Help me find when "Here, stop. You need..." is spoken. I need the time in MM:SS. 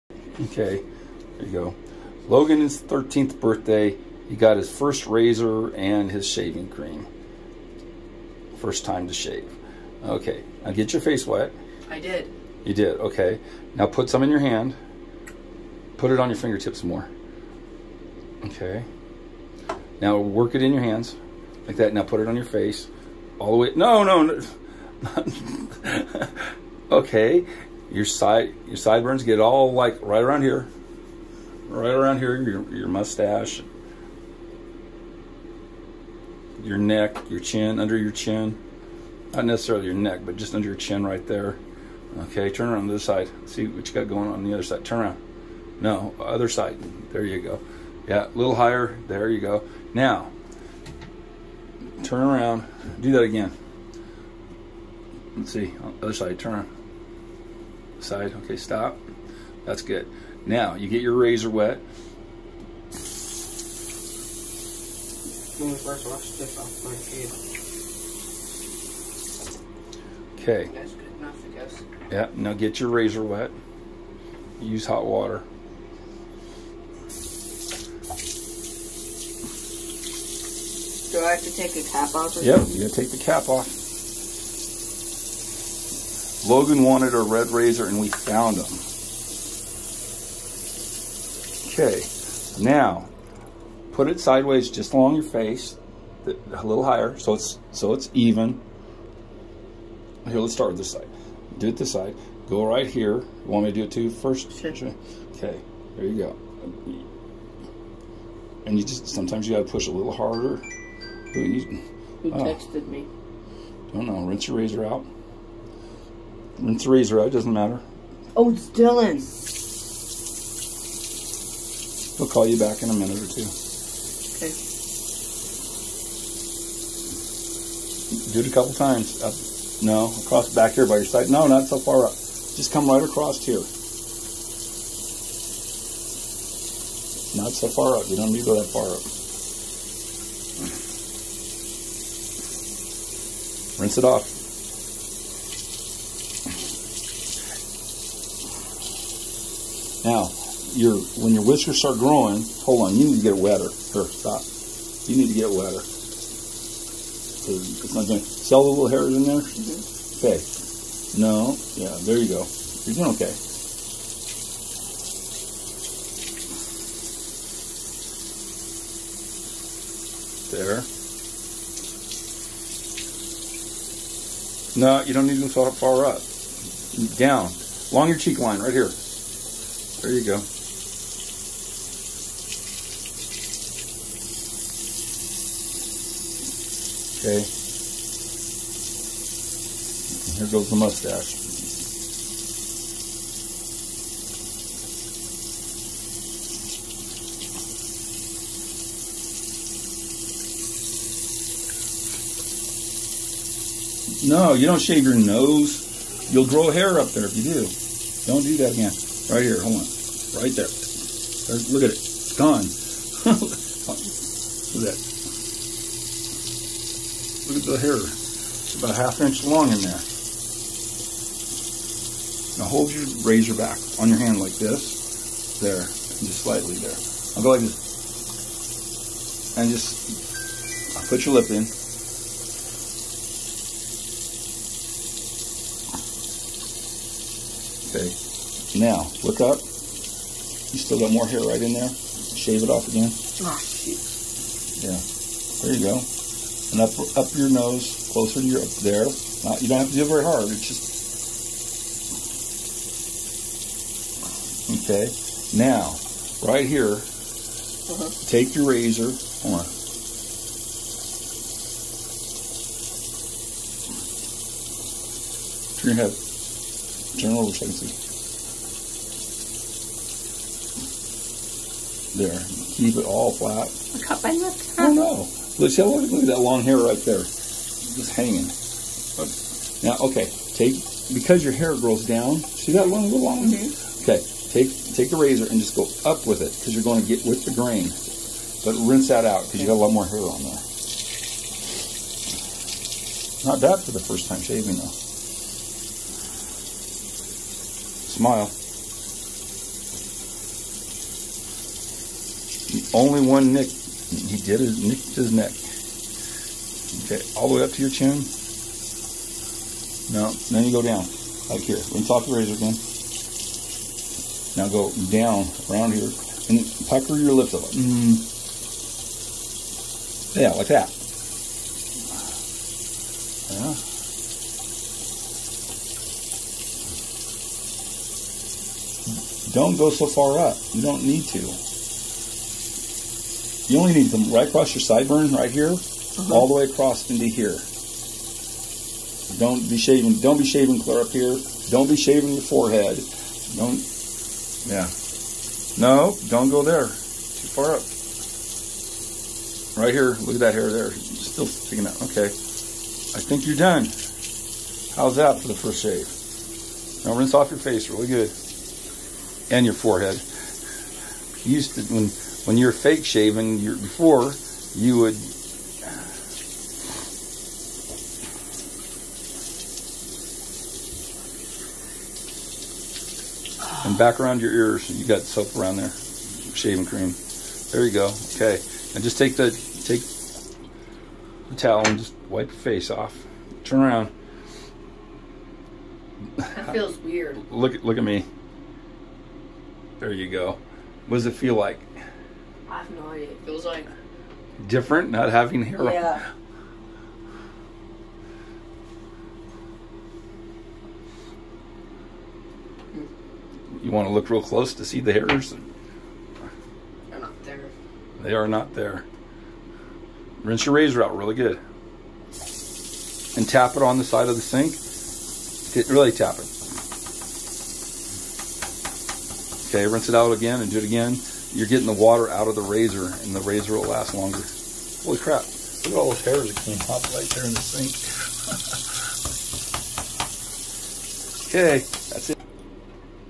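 02:33.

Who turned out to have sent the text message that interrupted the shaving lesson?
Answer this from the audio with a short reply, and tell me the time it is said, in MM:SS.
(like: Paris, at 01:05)
Dylan, at 01:58.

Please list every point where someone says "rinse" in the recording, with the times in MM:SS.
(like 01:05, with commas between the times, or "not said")
01:54, 02:23, 04:48, 05:57, 06:50, 06:59.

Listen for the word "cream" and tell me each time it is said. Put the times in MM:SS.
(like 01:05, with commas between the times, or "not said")
00:06, 06:16.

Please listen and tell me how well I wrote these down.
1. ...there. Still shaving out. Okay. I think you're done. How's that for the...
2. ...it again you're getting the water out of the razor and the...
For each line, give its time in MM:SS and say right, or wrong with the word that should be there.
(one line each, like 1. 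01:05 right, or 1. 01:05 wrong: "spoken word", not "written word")
1. 05:50 wrong: "sticking", not "shaving"
2. 07:00 right.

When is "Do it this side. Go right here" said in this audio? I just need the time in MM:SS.
01:41.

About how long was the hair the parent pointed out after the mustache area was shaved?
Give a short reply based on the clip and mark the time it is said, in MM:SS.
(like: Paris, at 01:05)
Half inch, at 03:38.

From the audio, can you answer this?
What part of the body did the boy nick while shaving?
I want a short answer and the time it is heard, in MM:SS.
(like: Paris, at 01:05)
His neck, at 05:04.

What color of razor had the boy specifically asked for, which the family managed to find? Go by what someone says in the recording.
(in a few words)
Red.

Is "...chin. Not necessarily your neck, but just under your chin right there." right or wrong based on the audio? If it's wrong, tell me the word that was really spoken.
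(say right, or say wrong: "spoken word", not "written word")
right.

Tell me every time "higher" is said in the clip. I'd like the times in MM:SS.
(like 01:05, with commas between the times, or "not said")
00:48, 01:36.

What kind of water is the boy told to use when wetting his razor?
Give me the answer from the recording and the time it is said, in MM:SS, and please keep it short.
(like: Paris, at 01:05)
Hot water, at 01:14.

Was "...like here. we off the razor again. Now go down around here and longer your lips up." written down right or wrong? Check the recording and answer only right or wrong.
wrong.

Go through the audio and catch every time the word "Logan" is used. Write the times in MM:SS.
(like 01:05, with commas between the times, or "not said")
00:02, 01:26.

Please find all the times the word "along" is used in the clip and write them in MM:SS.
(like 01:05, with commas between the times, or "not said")
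01:34, 02:57.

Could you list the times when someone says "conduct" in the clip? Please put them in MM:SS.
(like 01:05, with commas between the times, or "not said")
not said.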